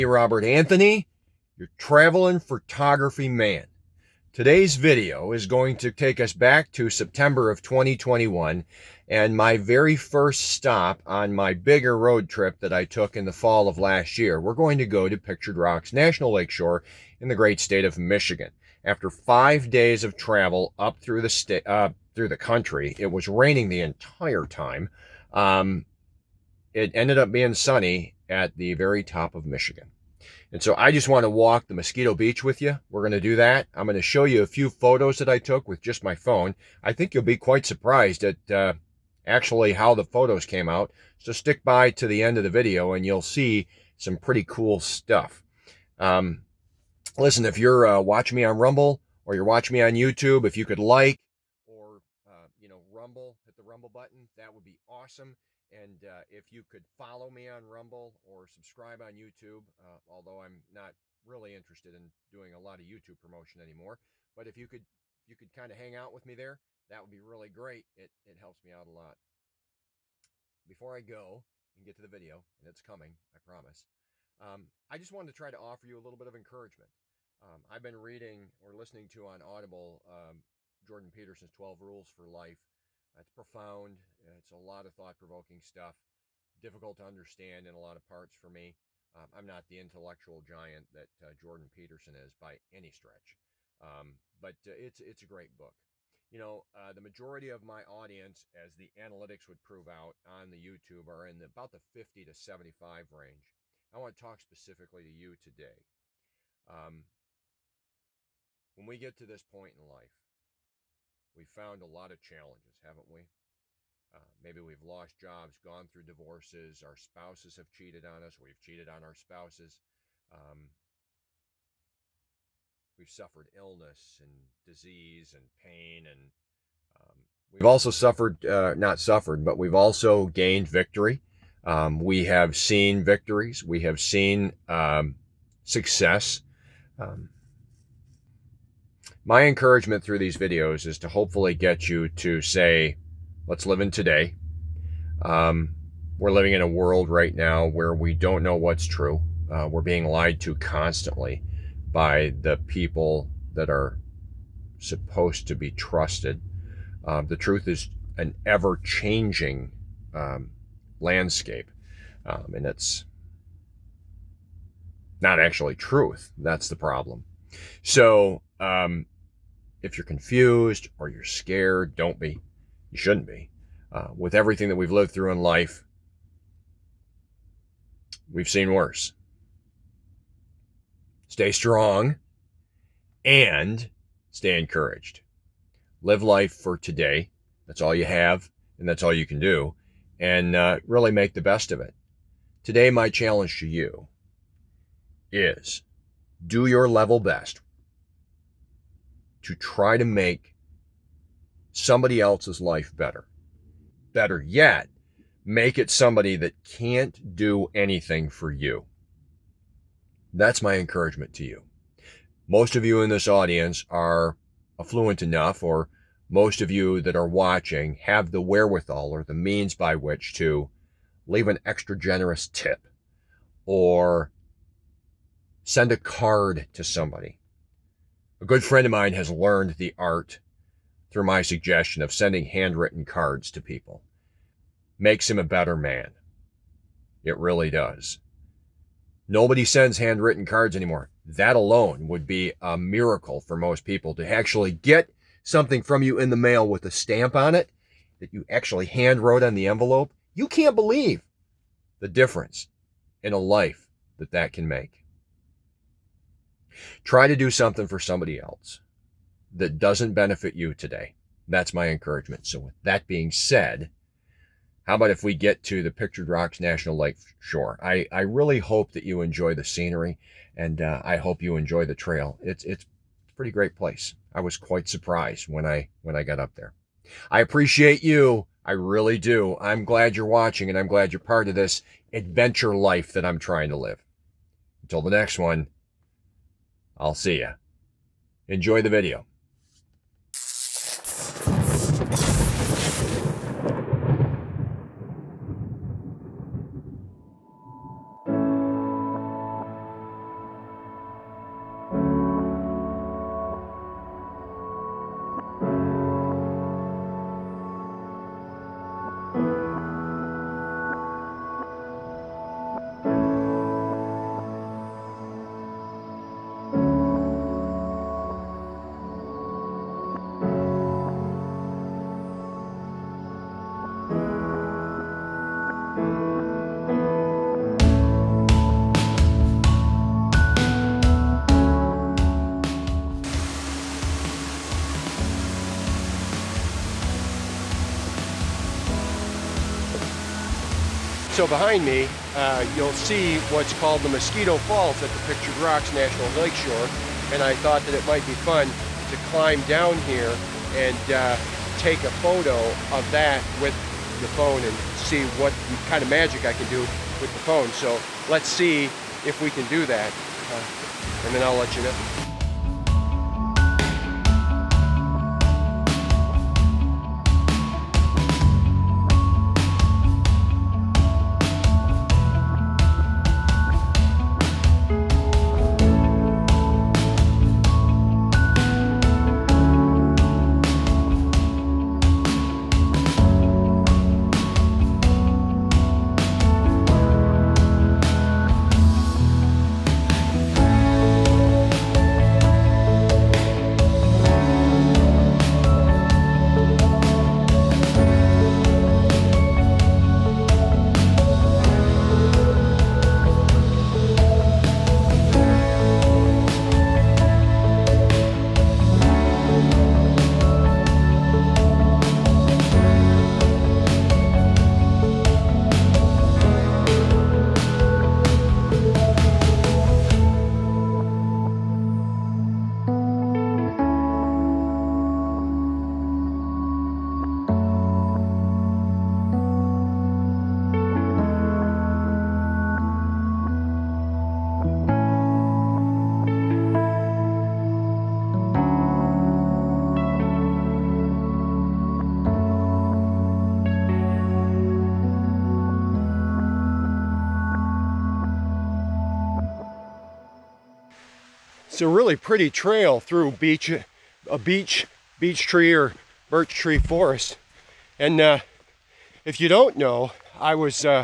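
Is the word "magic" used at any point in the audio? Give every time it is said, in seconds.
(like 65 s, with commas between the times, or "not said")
356 s.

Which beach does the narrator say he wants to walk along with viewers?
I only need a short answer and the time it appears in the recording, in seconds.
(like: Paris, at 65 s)
Mosquito Beach, at 31 s.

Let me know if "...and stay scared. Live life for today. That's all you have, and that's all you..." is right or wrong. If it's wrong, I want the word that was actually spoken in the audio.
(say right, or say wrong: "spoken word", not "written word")
wrong: "encouraged", not "scared".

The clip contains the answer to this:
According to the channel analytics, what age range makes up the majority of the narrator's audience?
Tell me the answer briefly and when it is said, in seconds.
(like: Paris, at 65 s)
50 to 75, at 101 s.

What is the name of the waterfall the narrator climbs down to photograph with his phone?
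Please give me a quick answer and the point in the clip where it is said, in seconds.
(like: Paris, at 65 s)
Mosquito Falls, at 344 s.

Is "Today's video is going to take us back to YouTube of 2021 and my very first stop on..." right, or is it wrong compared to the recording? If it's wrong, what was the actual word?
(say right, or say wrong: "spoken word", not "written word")
wrong: "September", not "YouTube".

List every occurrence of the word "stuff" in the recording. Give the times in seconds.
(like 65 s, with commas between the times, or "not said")
44 s, 85 s.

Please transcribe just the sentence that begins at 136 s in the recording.
Um, my encouragement through these videos is to hopefully get you to say, let's live in today.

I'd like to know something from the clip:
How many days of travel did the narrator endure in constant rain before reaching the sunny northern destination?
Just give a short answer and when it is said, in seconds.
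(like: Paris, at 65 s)
5, at 19 s.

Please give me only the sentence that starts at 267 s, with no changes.
I, I really hope that you enjoy the scenery and uh, I hope you enjoy the trail.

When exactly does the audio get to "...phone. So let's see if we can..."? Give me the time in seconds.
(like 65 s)
357 s.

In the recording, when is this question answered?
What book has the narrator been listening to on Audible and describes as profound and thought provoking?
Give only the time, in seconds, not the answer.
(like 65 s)
81 s.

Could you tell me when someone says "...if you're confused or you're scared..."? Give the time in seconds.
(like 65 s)
169 s.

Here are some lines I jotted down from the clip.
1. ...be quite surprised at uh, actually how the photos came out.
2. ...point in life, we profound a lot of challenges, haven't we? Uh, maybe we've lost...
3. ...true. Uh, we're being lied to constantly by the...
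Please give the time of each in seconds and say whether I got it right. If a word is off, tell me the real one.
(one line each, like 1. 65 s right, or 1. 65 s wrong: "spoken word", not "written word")
1. 37 s right
2. 109 s wrong: "found", not "profound"
3. 148 s right.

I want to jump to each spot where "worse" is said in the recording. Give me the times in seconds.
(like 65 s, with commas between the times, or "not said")
178 s.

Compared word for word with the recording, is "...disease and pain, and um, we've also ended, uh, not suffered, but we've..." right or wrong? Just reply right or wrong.
wrong.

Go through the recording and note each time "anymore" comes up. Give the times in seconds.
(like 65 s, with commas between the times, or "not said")
63 s, 240 s.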